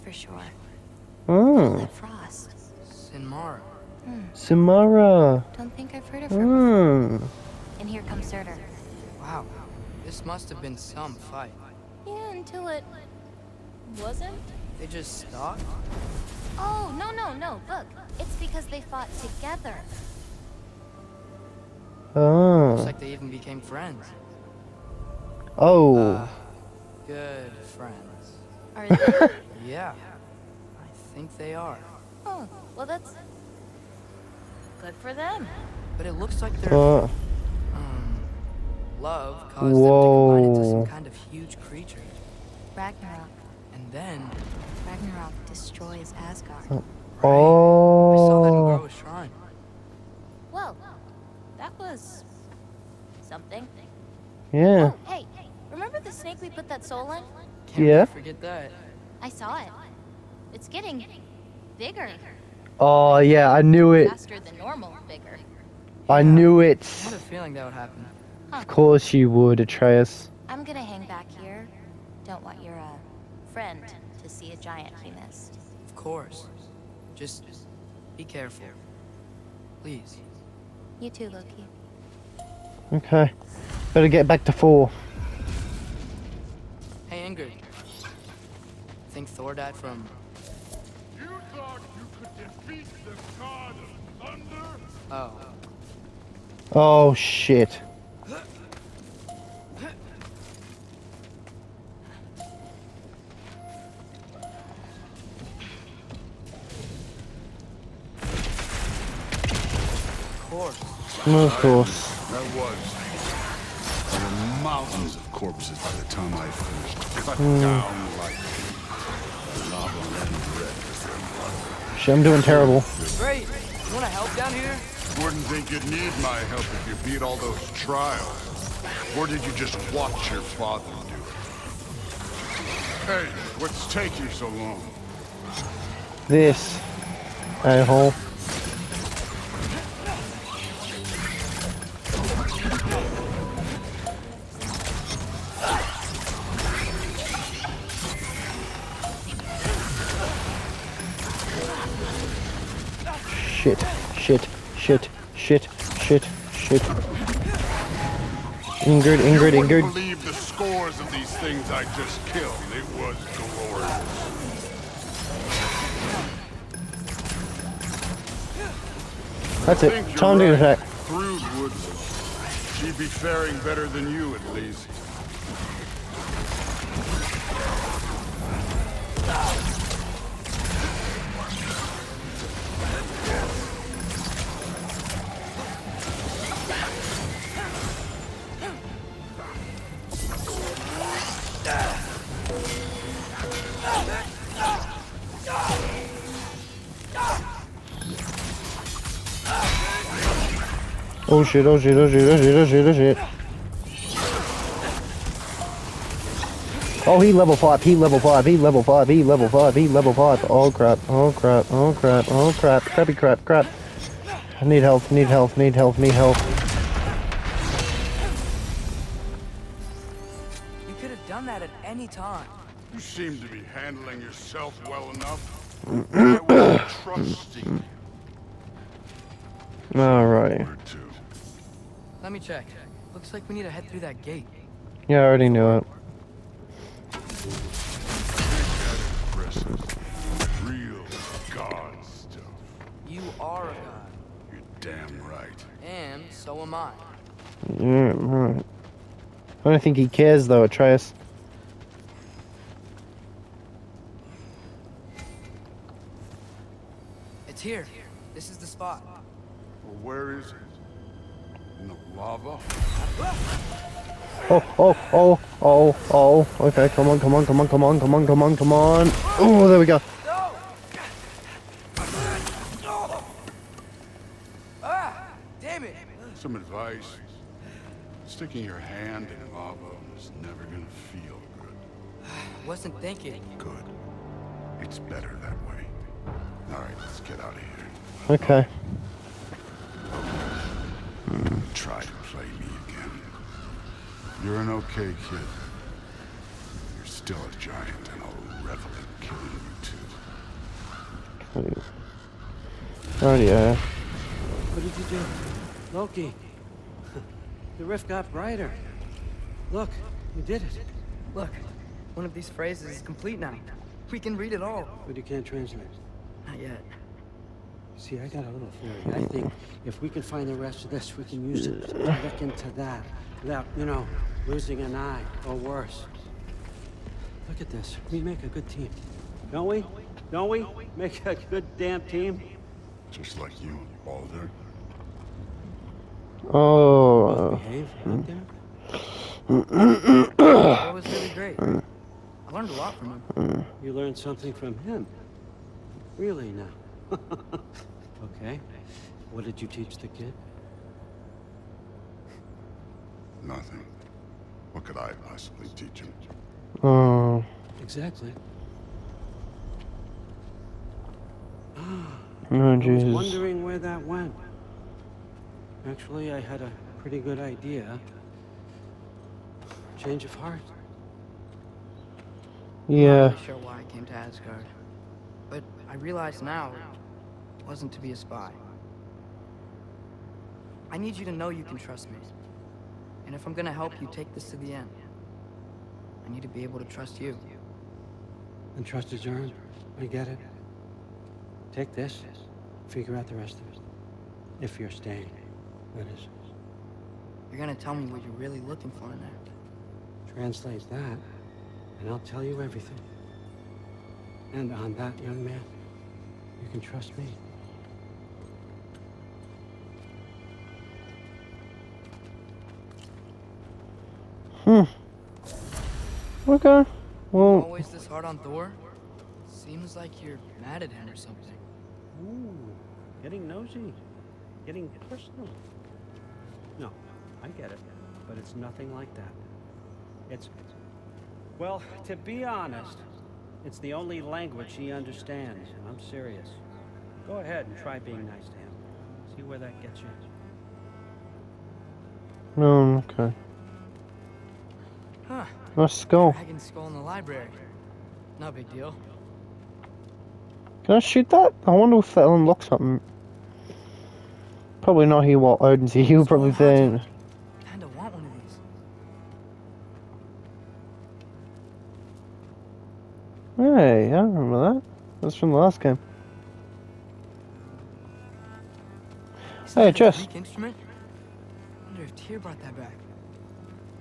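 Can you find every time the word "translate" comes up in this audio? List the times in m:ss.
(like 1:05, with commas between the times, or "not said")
5:15, 6:40.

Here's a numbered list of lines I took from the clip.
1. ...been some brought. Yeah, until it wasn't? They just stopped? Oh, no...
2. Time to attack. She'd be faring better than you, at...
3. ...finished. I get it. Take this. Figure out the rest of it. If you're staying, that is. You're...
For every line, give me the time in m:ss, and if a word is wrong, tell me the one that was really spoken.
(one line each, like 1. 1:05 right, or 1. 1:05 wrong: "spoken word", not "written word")
1. 0:10 wrong: "fight", not "brought"
2. 2:50 right
3. 6:29 wrong: "earned", not "finished".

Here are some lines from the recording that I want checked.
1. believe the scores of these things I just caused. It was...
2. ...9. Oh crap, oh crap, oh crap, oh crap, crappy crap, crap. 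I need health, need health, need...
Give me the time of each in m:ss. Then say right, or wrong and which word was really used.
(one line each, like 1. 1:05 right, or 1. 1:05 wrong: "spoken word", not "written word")
1. 2:39 wrong: "killed", not "caused"
2. 3:30 wrong: "5", not "9".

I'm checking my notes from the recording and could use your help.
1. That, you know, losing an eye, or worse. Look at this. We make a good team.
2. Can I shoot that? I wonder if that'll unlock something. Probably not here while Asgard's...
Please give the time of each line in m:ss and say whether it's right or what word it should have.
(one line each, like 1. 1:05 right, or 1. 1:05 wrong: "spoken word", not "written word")
1. 5:23 right
2. 7:30 wrong: "Odin", not "Asgard".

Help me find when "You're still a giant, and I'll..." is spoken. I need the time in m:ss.
4:56.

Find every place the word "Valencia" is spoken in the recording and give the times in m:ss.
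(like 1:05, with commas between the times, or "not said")
not said.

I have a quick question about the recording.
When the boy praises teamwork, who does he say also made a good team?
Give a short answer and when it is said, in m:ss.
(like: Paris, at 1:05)
Balder, at 5:34.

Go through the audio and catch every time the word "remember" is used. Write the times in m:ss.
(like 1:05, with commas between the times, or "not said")
0:55, 7:44.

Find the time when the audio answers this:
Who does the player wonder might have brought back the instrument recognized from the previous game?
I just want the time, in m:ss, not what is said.
7:52.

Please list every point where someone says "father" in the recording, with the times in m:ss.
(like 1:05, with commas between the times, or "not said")
2:10.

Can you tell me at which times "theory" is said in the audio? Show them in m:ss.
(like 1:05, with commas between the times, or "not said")
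5:18.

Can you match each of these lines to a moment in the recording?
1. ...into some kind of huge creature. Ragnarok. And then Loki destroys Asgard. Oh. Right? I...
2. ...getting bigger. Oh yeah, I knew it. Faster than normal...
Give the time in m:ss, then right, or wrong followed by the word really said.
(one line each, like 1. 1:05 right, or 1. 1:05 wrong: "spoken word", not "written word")
1. 0:40 wrong: "Ragnarok", not "Loki"
2. 1:00 right.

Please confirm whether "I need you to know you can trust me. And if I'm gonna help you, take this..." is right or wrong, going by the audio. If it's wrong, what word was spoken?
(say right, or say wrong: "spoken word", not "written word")
right.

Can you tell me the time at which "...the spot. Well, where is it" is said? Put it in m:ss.
4:18.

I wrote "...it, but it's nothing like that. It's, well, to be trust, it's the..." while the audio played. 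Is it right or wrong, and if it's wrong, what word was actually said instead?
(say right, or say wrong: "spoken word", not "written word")
wrong: "honest", not "trust".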